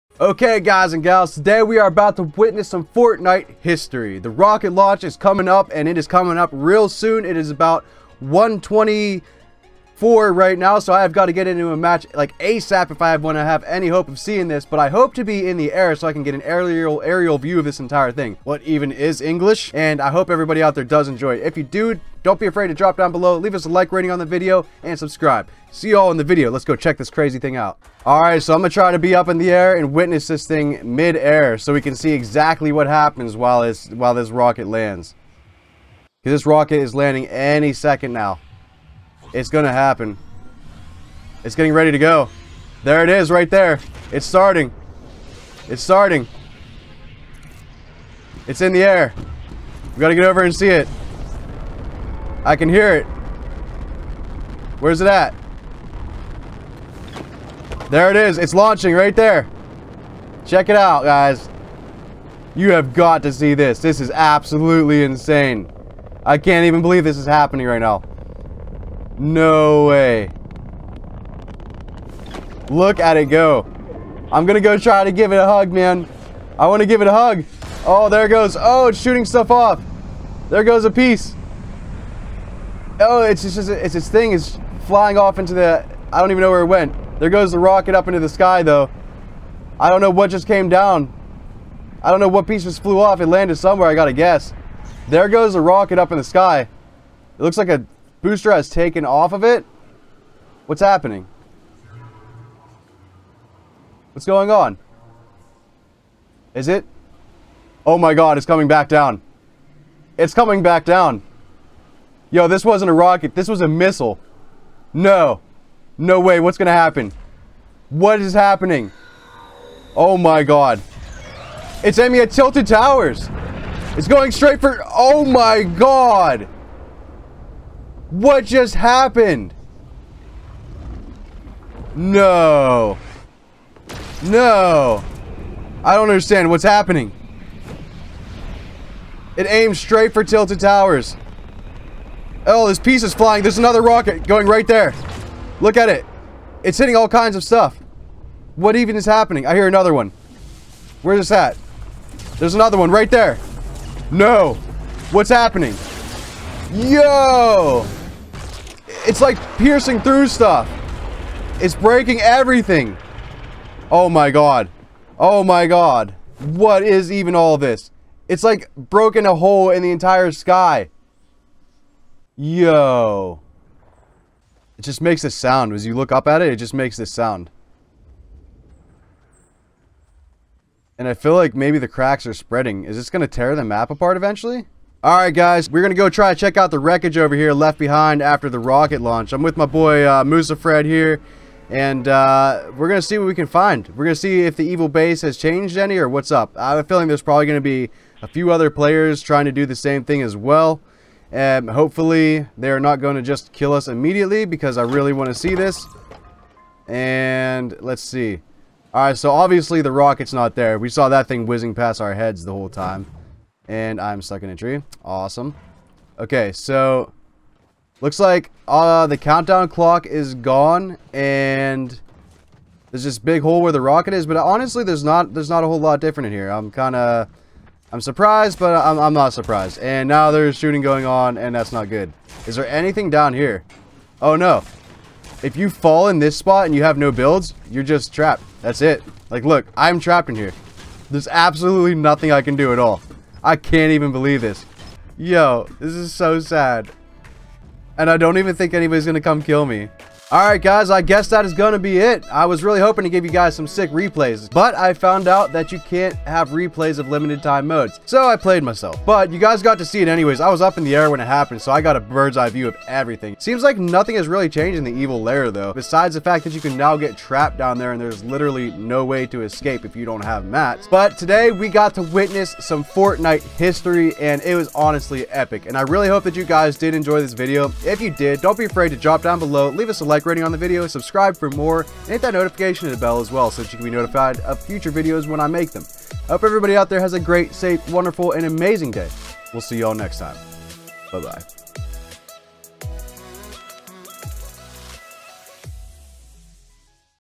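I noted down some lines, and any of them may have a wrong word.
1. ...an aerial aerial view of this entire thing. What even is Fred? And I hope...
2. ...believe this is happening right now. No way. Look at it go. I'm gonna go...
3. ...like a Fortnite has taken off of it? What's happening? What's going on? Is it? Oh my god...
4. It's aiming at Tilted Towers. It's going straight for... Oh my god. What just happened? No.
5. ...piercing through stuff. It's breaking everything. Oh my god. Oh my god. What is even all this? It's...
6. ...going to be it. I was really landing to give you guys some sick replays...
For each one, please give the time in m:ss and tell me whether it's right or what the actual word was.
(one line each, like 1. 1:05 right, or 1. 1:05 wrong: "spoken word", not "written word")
1. 0:16 wrong: "English", not "Fred"
2. 1:06 right
3. 1:37 wrong: "Booster", not "Fortnite"
4. 2:01 right
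5. 2:39 right
6. 4:11 wrong: "hoping", not "landing".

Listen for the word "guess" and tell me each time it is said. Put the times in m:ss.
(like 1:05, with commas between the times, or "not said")
1:34, 4:11.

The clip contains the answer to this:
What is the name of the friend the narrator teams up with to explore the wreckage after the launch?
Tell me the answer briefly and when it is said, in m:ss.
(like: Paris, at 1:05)
Musa Fred, at 3:10.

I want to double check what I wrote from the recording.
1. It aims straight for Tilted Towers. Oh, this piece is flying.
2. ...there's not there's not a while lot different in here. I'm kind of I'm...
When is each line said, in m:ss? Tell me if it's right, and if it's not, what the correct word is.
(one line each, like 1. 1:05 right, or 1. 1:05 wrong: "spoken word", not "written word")
1. 2:19 right
2. 3:44 wrong: "whole", not "while".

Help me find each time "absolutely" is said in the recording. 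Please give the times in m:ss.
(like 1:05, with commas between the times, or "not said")
1:04, 4:01.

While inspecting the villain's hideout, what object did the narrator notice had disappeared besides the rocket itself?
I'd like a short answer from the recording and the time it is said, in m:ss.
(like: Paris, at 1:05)
The countdown clock, at 3:39.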